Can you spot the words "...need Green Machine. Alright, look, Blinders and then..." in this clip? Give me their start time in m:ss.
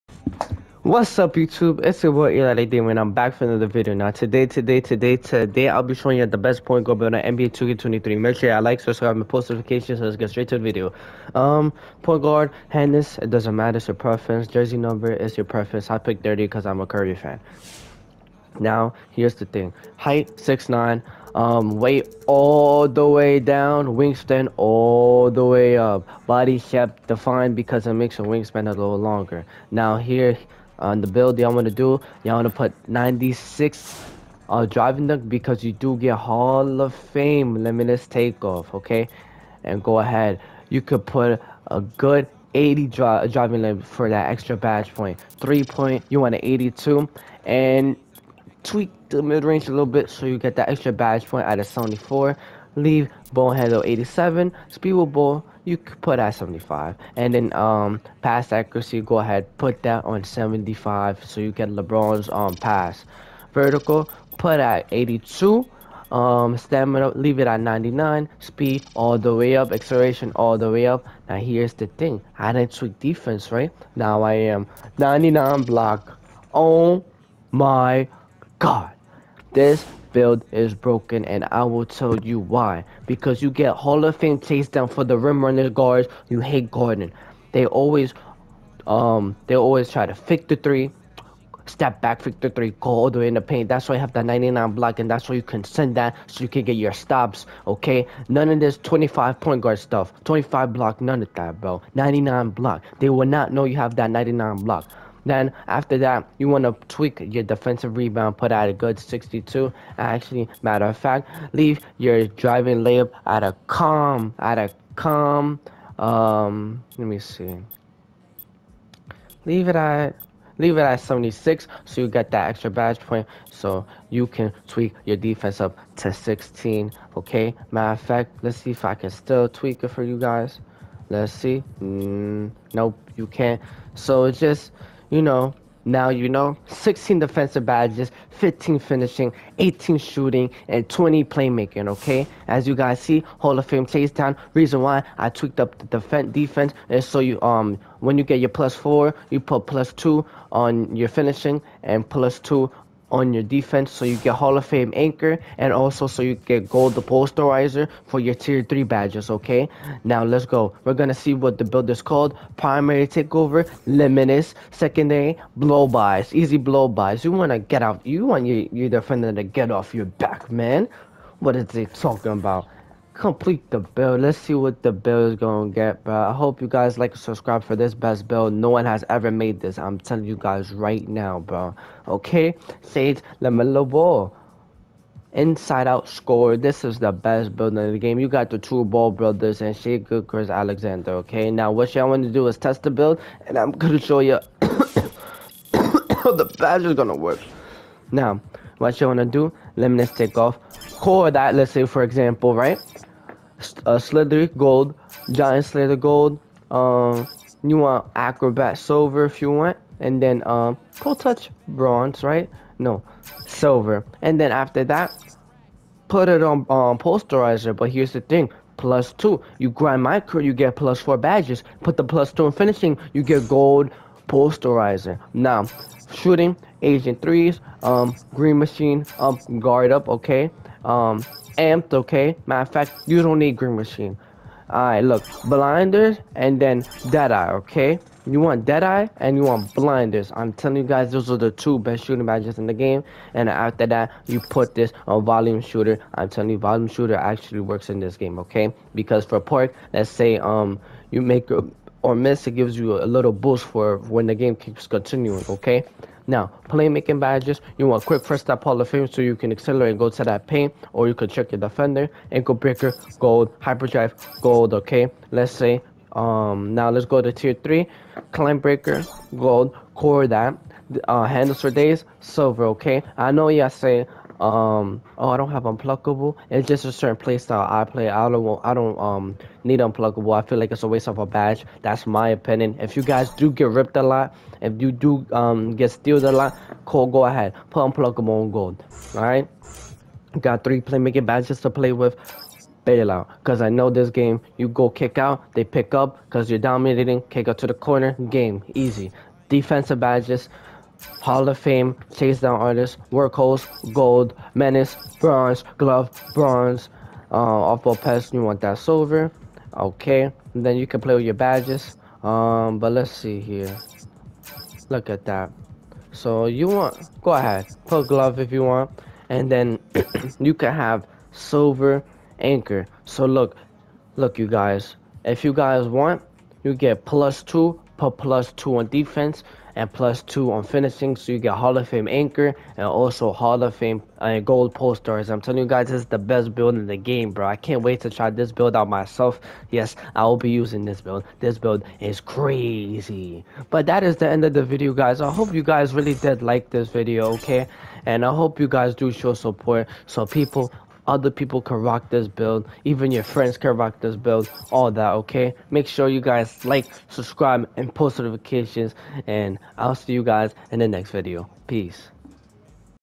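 3:53.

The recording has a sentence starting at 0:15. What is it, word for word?
I picked 30 because I'm a Curry fan.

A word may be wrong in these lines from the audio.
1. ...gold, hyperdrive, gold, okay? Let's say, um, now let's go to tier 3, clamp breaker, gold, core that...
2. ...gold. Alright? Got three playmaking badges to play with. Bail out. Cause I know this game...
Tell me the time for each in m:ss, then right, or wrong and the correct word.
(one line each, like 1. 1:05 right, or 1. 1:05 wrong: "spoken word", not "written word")
1. 4:23 right
2. 4:48 right.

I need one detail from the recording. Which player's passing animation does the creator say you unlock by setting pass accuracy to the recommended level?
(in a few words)
LeBron.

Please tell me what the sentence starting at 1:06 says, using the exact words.
Um, stamina, leave it at 99.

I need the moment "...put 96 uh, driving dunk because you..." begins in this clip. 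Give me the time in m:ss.
0:32.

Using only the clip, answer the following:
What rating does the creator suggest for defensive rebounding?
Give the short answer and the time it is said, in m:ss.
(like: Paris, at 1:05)
62, at 1:48.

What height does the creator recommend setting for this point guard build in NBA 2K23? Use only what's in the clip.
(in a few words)
6'9".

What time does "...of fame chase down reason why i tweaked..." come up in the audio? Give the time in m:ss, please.
2:23.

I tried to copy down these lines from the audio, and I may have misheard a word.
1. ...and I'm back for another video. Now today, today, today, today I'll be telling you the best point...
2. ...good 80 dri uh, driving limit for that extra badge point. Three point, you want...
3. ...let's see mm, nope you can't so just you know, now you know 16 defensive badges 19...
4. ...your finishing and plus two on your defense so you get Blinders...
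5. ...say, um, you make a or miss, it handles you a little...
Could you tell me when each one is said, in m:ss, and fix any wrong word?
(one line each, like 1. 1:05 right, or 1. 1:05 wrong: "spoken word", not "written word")
1. 0:02 wrong: "showing", not "telling"
2. 0:41 right
3. 2:11 wrong: "15", not "19"
4. 2:30 wrong: "Hall", not "Blinders"
5. 4:10 wrong: "gives", not "handles".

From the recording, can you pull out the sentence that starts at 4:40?
I feel like it's a waste of a badge.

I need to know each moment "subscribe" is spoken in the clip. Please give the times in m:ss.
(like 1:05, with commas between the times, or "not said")
0:08, 2:57, 5:57.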